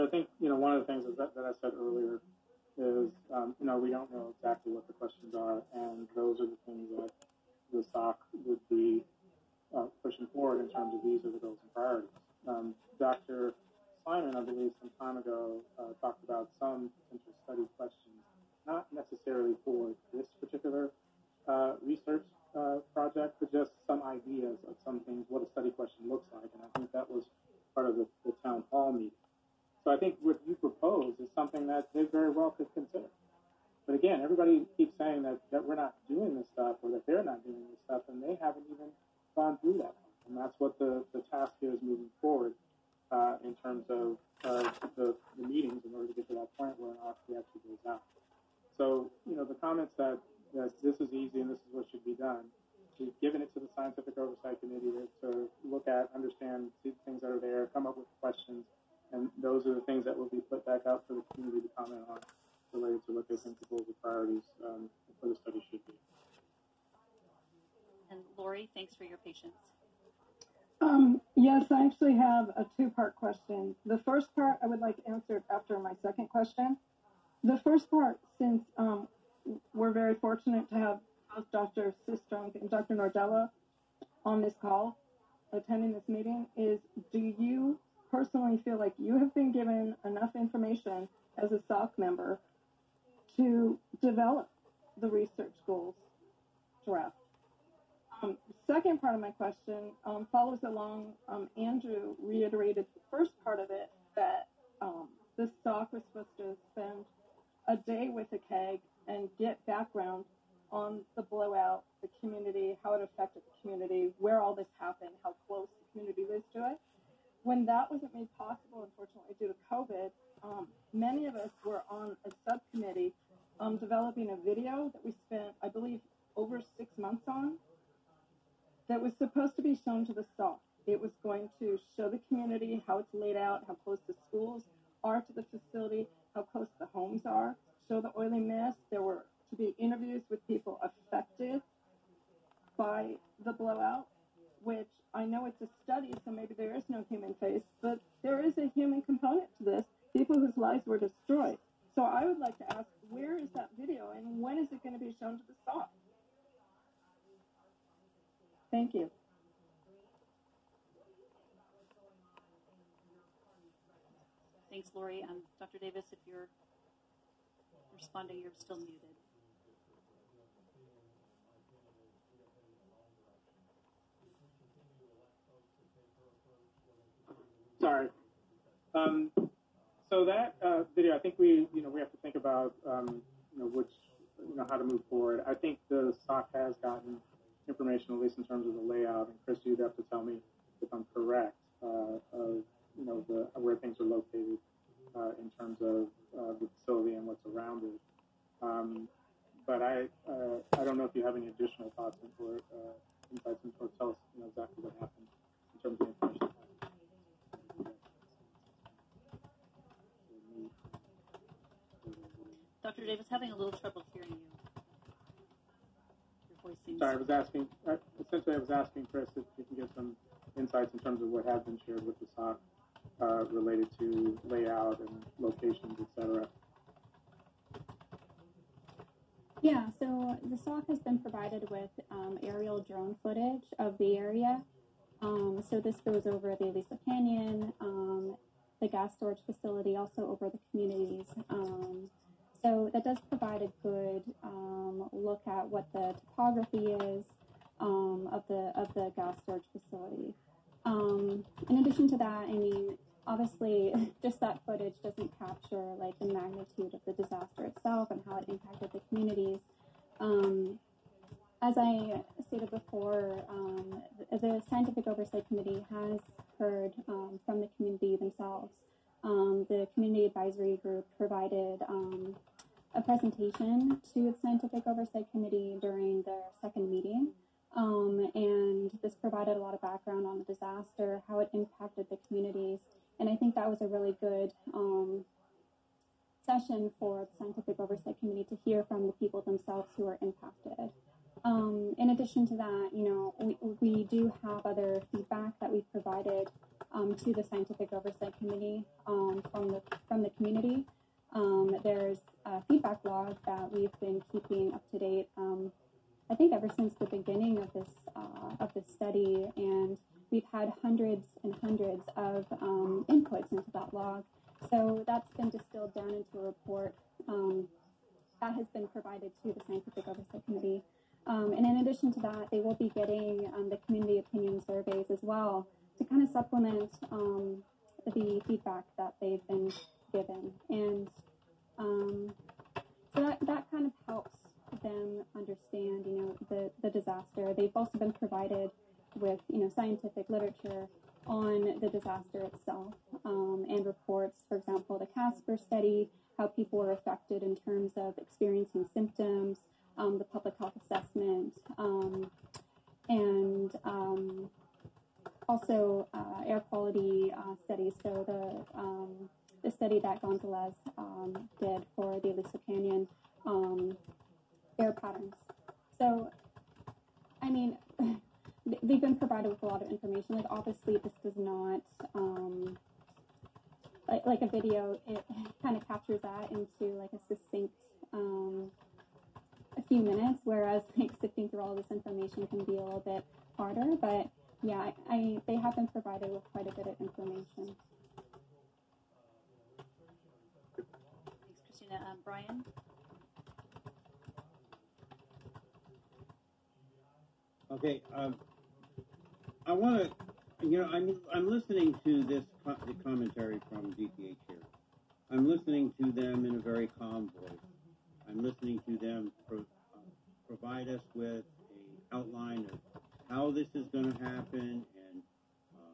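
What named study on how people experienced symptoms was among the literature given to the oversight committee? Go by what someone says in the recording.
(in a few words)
Casper study.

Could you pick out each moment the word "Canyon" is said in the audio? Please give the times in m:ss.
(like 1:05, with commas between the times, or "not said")
3:57, 6:02.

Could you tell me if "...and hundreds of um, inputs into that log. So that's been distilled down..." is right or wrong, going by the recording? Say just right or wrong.
right.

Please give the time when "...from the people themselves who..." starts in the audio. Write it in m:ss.
4:48.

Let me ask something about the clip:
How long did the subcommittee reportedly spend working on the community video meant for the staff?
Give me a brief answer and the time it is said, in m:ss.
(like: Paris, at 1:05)
over six months, at 2:06.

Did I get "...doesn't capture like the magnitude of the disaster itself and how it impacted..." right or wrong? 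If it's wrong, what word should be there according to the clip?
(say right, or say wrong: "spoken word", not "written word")
right.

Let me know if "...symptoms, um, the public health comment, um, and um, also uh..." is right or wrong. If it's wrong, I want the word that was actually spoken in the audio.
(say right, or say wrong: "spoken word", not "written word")
wrong: "assessment", not "comment".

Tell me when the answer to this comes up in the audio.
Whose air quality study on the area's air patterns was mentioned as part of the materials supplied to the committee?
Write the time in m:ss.
6:00.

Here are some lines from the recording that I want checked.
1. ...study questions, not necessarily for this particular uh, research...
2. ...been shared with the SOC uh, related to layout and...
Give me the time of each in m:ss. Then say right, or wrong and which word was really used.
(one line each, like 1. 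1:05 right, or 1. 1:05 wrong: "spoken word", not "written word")
1. 0:17 right
2. 3:41 right.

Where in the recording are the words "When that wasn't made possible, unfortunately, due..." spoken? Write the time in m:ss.
1:57.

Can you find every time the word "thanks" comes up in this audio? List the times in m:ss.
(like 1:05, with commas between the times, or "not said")
1:08, 2:38, 2:44, 6:30.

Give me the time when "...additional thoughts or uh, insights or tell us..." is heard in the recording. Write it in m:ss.
3:21.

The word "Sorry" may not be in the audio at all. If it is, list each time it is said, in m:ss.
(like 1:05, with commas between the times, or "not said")
2:57, 3:36.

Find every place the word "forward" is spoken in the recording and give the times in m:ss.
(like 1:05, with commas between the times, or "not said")
0:10, 0:42, 3:05.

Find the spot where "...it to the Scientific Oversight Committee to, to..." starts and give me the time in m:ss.
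0:53.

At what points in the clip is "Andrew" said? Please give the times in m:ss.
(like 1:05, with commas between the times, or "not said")
1:41.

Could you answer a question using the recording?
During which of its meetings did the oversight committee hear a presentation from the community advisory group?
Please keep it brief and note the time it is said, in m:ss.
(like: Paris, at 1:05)
second meeting, at 4:36.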